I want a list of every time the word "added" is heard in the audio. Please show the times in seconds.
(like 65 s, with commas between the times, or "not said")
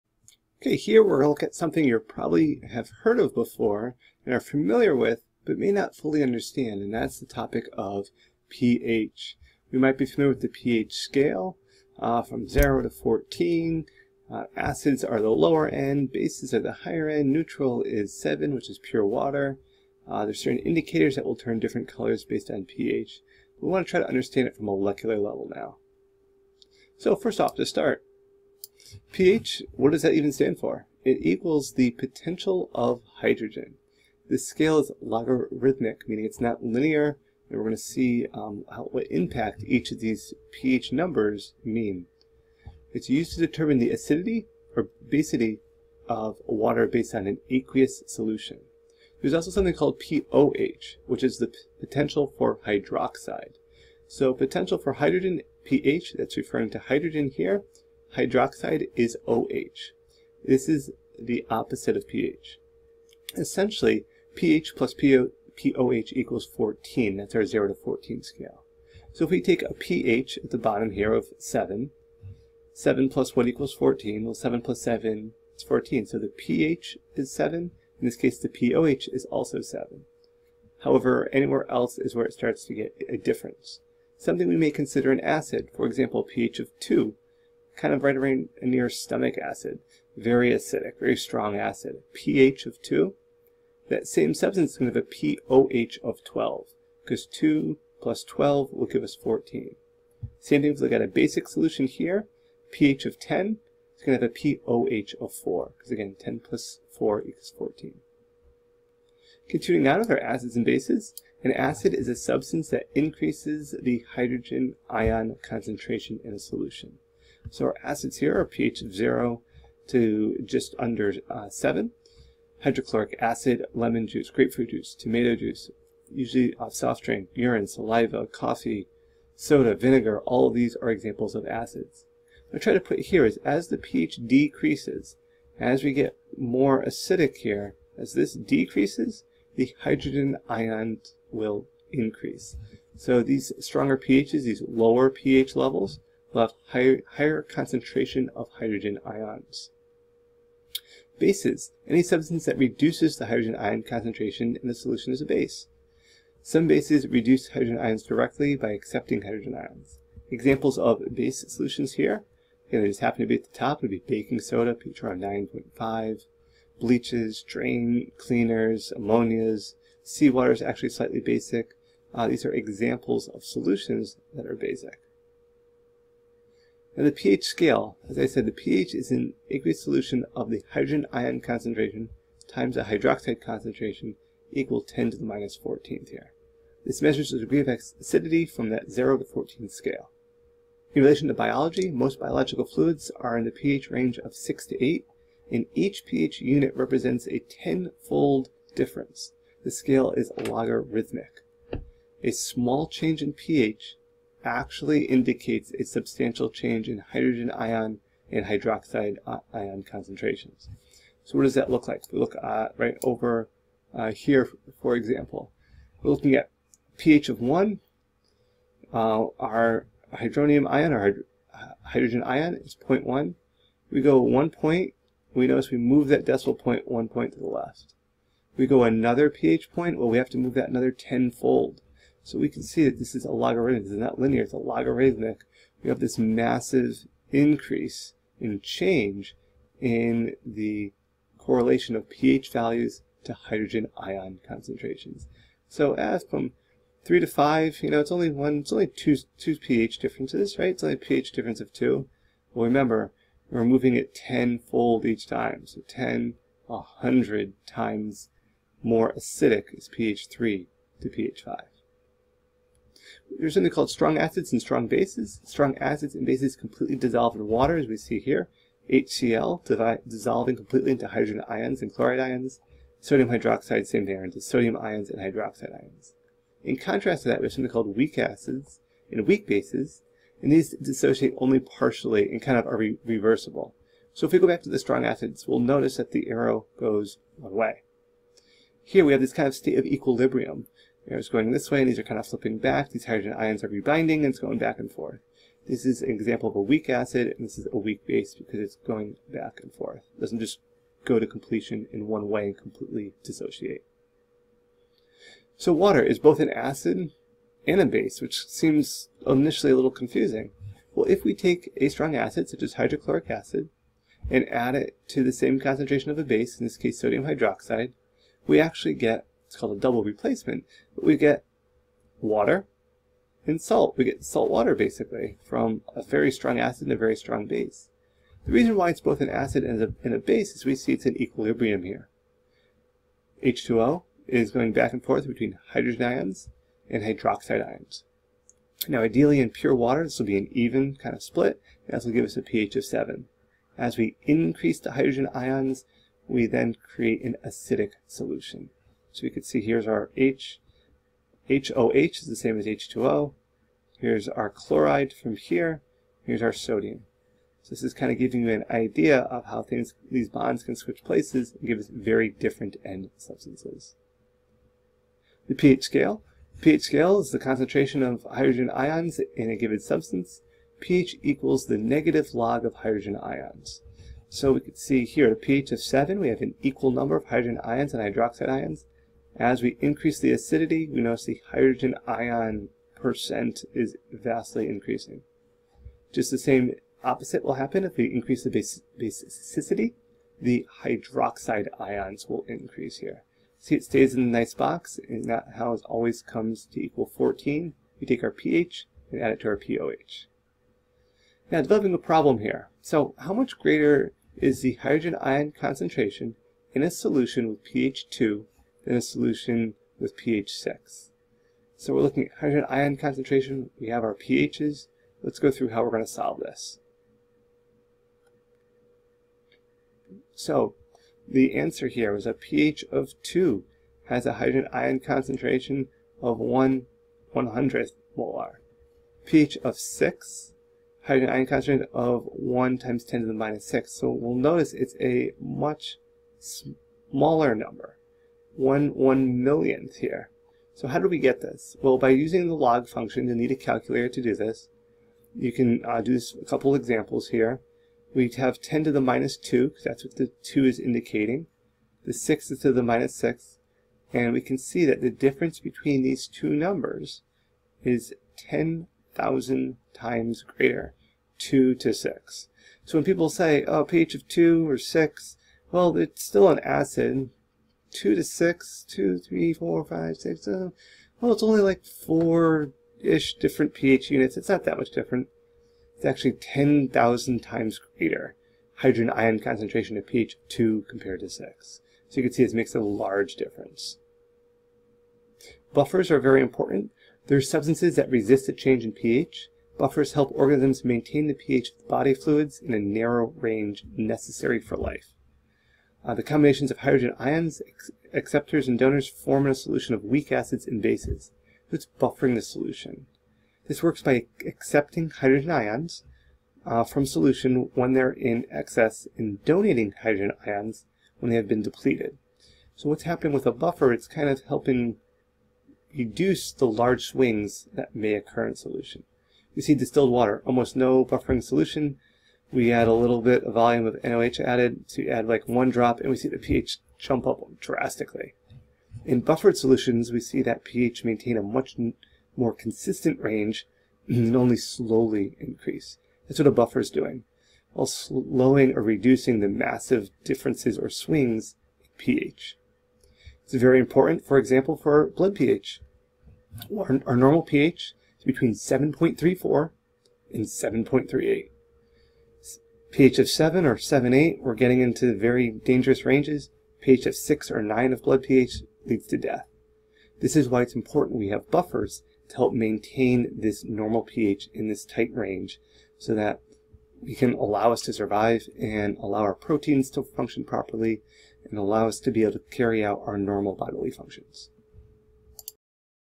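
524 s.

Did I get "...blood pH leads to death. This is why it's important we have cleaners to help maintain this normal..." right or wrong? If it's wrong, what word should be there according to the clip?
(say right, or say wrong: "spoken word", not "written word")
wrong: "buffers", not "cleaners".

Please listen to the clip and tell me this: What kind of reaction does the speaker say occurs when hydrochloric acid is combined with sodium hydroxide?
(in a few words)
double replacement.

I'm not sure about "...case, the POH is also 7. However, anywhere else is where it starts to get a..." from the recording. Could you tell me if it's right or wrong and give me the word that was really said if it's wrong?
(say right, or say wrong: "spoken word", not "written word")
right.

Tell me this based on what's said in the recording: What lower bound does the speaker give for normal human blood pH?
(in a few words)
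7.34.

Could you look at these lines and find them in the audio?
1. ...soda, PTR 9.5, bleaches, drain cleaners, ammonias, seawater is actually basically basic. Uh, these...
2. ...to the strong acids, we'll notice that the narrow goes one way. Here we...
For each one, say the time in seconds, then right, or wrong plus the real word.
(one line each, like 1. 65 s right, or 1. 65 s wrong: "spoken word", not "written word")
1. 164 s wrong: "slightly", not "basically"
2. 284 s wrong: "arrow", not "narrow".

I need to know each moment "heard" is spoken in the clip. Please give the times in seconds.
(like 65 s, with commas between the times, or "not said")
3 s.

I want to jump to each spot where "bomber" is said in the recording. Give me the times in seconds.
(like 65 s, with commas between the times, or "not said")
not said.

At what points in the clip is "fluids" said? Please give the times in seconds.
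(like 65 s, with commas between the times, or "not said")
192 s, 492 s.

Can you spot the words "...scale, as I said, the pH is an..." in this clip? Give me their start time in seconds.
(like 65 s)
177 s.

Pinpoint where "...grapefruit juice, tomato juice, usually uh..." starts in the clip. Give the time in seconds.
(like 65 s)
124 s.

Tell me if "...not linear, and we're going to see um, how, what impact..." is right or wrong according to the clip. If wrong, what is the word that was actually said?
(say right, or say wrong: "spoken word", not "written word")
right.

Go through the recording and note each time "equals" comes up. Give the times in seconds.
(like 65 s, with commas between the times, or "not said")
31 s, 66 s, 73 s, 107 s, 184 s, 371 s, 376 s, 396 s.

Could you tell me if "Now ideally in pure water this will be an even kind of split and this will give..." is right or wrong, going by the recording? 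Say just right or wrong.
right.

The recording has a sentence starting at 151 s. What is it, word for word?
Bases, any substance that reduces the hydrogen ion concentration in the solution is a base.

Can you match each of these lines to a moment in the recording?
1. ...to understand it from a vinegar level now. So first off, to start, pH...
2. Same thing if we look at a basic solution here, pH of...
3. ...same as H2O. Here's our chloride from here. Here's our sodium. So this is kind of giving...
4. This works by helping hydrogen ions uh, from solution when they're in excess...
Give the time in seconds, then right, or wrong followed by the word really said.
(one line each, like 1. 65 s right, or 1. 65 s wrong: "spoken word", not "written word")
1. 23 s wrong: "molecular", not "vinegar"
2. 100 s right
3. 352 s right
4. 503 s wrong: "accepting", not "helping".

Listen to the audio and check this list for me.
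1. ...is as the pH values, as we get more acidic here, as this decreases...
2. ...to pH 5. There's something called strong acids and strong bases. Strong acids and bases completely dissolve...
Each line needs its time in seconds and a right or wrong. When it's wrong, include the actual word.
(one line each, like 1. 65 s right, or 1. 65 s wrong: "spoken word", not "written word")
1. 133 s wrong: "decreases", not "values"
2. 261 s right.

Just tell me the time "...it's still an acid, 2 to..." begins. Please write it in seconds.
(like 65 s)
465 s.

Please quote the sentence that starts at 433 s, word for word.
So we'll notice it's a much smaller number one one millionth here.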